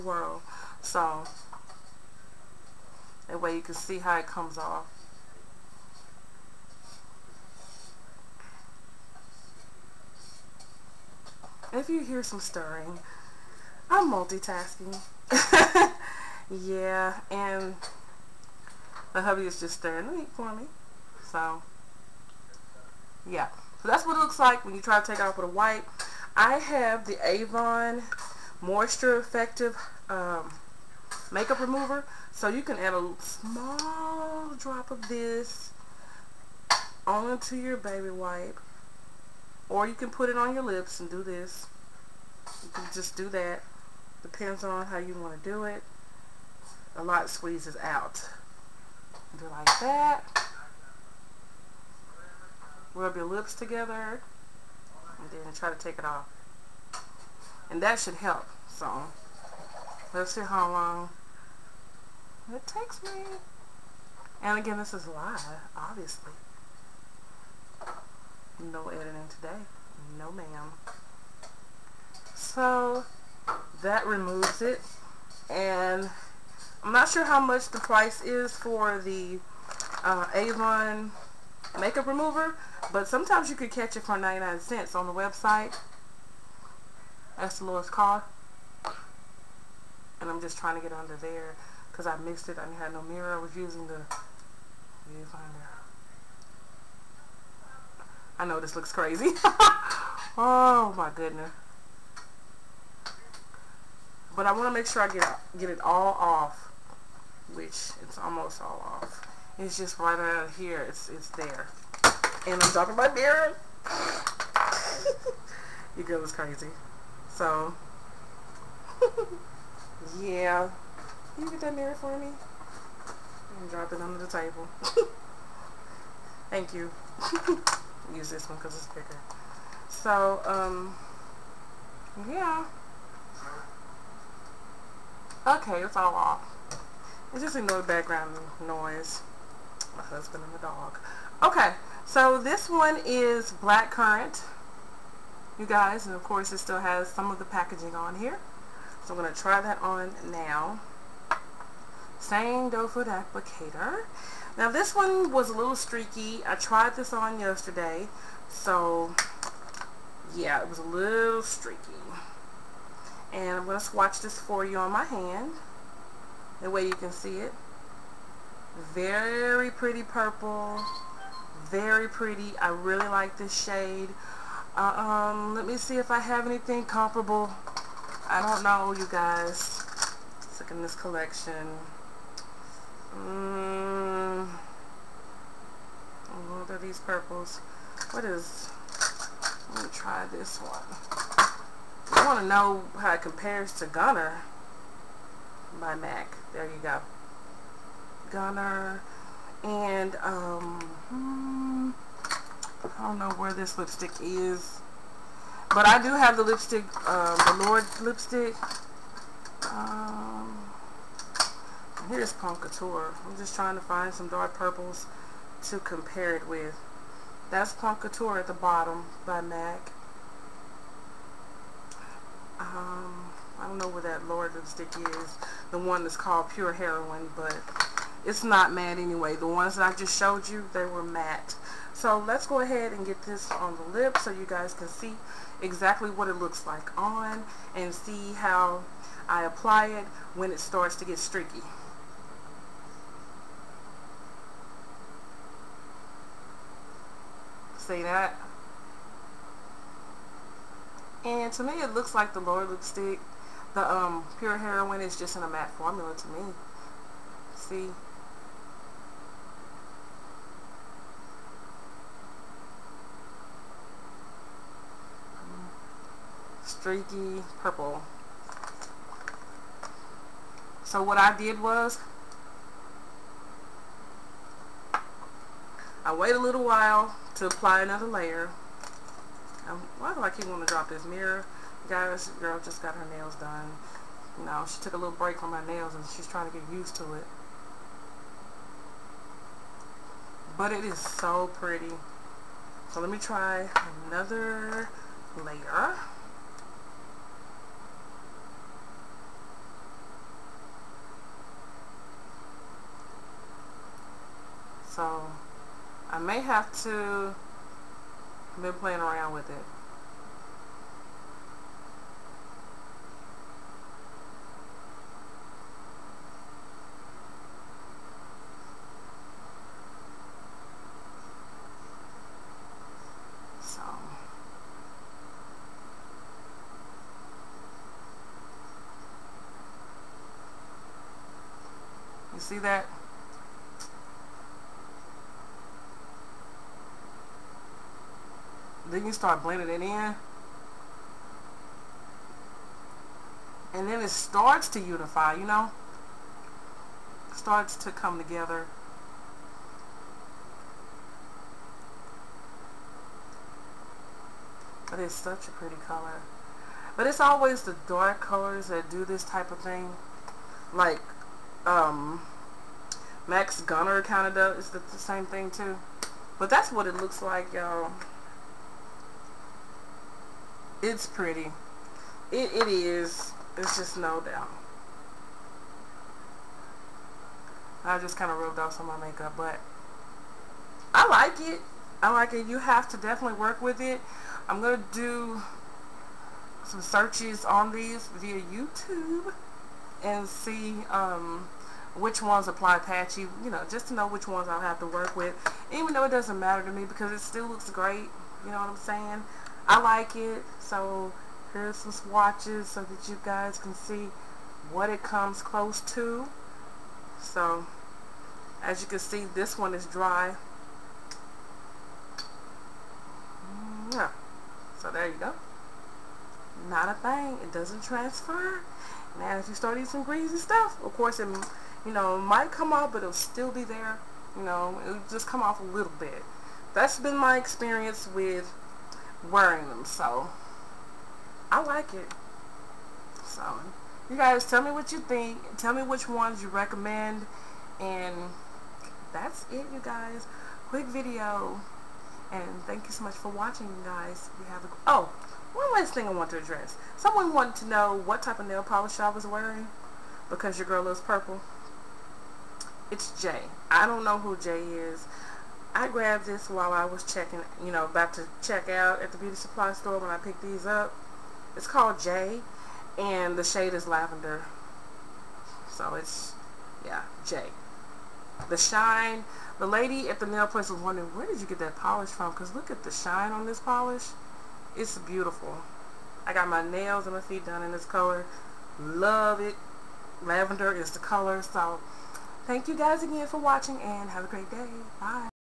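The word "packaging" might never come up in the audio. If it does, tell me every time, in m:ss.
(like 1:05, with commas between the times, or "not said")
2:27.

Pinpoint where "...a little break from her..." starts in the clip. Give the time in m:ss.
4:44.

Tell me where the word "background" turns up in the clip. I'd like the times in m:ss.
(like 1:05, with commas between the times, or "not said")
2:17.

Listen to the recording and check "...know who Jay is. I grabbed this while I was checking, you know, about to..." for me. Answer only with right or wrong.
right.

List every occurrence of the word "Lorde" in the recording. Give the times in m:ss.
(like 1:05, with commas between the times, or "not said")
3:27, 3:44, 4:12.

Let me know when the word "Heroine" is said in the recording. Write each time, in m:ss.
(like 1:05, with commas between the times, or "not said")
3:46, 4:14.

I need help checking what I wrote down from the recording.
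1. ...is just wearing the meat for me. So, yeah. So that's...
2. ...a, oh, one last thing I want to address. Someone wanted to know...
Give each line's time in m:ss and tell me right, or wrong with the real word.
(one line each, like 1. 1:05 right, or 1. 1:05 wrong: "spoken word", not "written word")
1. 0:19 wrong: "stirring", not "wearing"
2. 7:24 right.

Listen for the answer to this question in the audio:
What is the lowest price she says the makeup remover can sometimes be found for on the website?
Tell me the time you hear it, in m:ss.
1:24.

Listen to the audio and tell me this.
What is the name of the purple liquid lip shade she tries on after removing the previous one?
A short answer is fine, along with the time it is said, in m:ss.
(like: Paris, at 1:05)
Black currant, at 2:23.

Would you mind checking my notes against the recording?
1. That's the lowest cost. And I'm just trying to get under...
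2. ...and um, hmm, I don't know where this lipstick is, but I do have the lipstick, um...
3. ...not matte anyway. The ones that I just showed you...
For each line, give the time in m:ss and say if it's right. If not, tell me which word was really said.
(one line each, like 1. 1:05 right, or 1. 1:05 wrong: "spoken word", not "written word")
1. 1:27 right
2. 3:19 right
3. 3:48 right.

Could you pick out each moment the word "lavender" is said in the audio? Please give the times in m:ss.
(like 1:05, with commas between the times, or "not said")
7:43, 8:00.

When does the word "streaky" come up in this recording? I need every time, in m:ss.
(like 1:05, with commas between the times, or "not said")
2:35, 2:41, 4:01, 4:26.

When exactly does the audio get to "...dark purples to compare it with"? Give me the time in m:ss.
3:34.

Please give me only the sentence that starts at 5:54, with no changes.
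But it's such a pretty color.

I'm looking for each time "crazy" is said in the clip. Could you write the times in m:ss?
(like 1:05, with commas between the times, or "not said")
1:38, 1:56.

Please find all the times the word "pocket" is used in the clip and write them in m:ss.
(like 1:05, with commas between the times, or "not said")
not said.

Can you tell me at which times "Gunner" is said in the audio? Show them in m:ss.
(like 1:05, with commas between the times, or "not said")
3:13, 3:18, 6:03.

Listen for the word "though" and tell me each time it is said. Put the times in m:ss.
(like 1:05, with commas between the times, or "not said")
6:35.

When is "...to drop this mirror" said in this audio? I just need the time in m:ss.
4:40.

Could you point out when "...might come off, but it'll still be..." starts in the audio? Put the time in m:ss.
7:02.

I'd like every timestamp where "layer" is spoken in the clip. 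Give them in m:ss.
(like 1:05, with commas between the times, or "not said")
4:38, 4:55.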